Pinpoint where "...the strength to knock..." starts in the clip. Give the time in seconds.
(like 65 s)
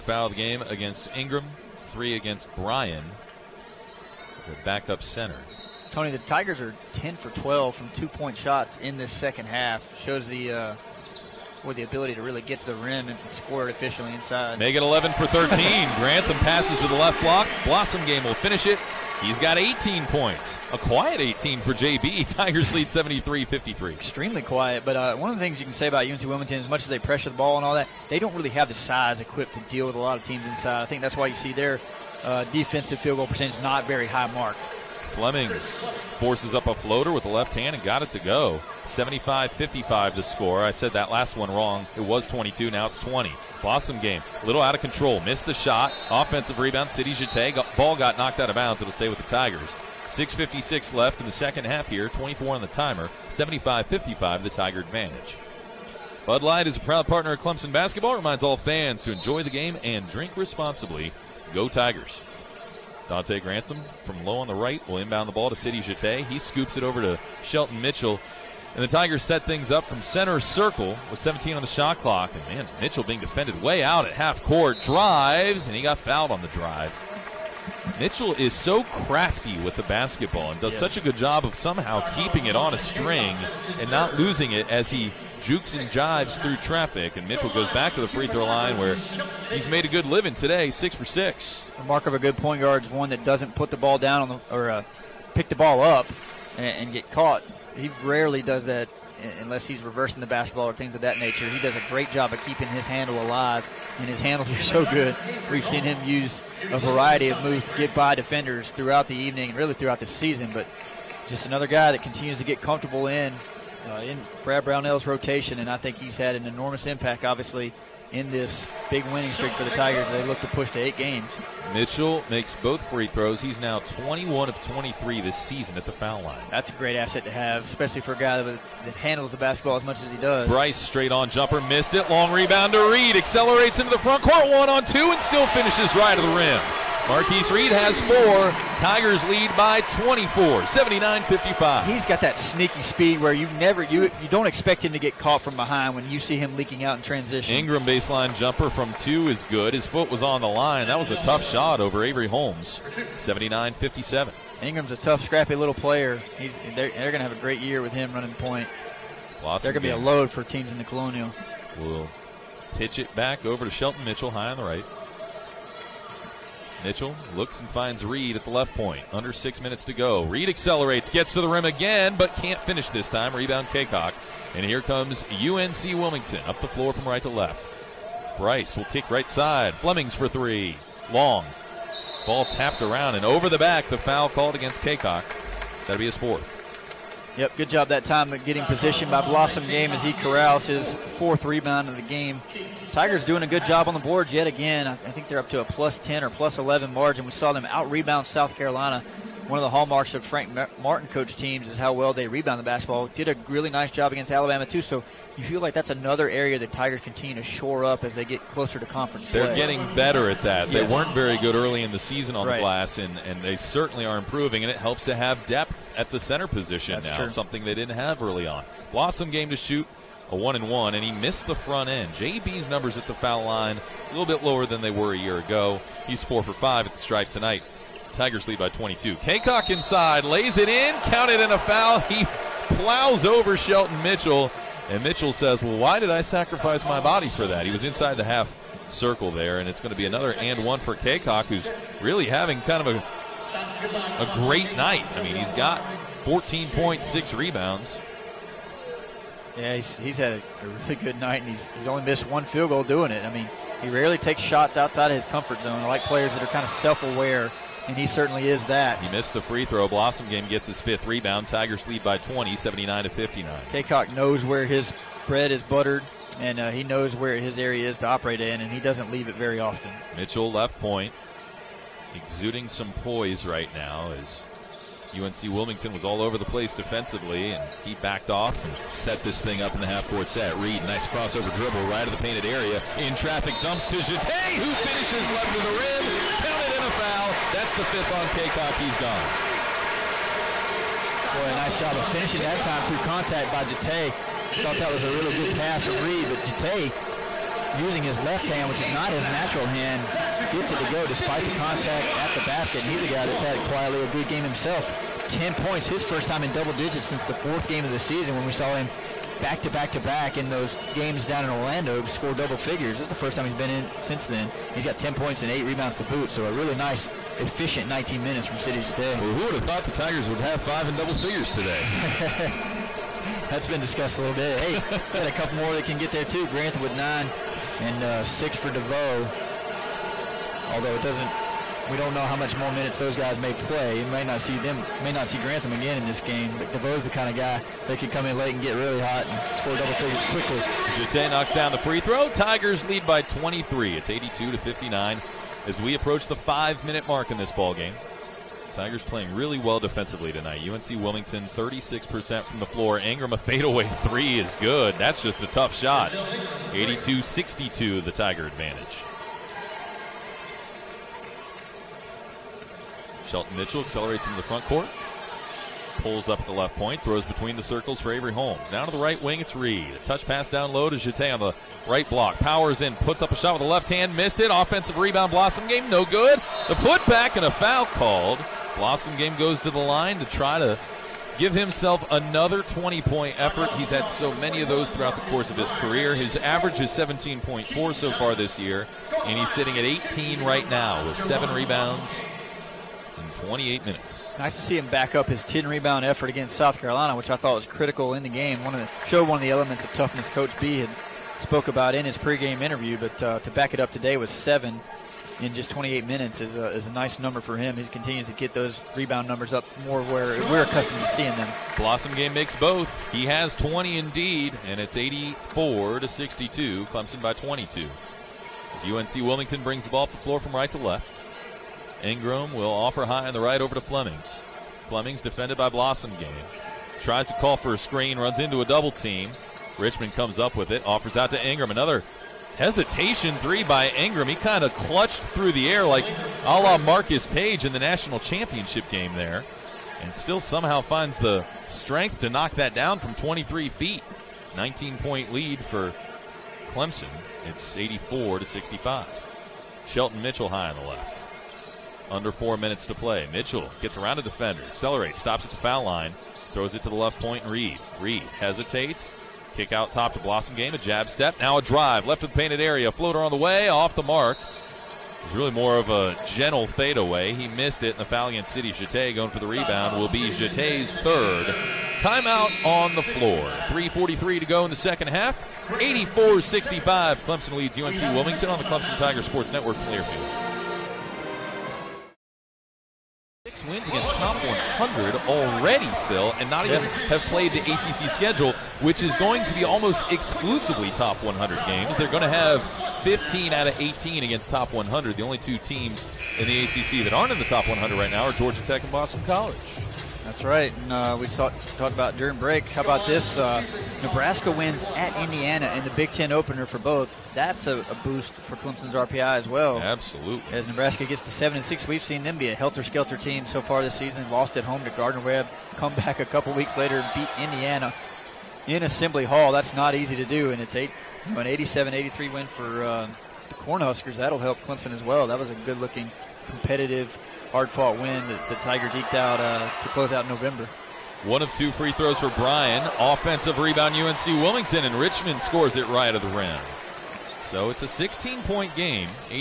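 441 s.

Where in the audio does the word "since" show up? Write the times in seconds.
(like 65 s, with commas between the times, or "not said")
307 s, 314 s.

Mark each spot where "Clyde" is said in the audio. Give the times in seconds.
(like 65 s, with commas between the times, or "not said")
not said.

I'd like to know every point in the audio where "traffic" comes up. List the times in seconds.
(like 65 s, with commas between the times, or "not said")
86 s, 283 s.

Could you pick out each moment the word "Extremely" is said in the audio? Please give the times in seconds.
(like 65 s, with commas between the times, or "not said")
23 s.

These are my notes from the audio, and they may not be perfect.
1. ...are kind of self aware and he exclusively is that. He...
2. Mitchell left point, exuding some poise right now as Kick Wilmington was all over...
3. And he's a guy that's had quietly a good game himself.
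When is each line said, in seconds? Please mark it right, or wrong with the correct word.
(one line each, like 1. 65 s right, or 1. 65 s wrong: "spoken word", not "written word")
1. 256 s wrong: "certainly", not "exclusively"
2. 270 s wrong: "UNC", not "Kick"
3. 302 s right.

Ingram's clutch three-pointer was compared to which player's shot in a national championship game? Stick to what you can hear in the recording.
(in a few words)
Marcus Paige.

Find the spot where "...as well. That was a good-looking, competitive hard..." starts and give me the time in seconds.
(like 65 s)
524 s.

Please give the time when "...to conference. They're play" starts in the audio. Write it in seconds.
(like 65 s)
208 s.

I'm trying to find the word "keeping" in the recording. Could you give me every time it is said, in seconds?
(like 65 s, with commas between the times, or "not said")
82 s, 102 s.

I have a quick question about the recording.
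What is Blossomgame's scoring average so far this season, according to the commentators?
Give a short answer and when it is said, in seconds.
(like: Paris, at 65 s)
17.4, at 386 s.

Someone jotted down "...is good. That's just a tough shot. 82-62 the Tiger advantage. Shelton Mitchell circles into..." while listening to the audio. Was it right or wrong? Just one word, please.
wrong.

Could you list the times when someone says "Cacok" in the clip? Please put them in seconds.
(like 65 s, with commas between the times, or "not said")
173 s, 184 s, 229 s, 240 s, 263 s, 288 s.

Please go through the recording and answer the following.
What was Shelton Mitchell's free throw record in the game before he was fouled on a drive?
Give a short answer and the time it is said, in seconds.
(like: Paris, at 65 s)
6 for 6, at 90 s.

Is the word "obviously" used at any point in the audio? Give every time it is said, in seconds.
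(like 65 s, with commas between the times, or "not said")
117 s.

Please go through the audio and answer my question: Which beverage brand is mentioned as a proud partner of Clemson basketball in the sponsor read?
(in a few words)
Bud Light.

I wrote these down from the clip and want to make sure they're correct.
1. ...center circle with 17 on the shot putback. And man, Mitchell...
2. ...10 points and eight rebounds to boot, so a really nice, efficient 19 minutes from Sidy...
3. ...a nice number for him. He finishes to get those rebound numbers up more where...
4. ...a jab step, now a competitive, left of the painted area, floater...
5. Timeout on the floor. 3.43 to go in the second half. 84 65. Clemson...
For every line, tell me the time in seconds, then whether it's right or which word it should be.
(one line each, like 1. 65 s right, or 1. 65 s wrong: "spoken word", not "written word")
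1. 70 s wrong: "clock", not "putback"
2. 314 s right
3. 406 s wrong: "continues", not "finishes"
4. 460 s wrong: "drive", not "competitive"
5. 471 s right.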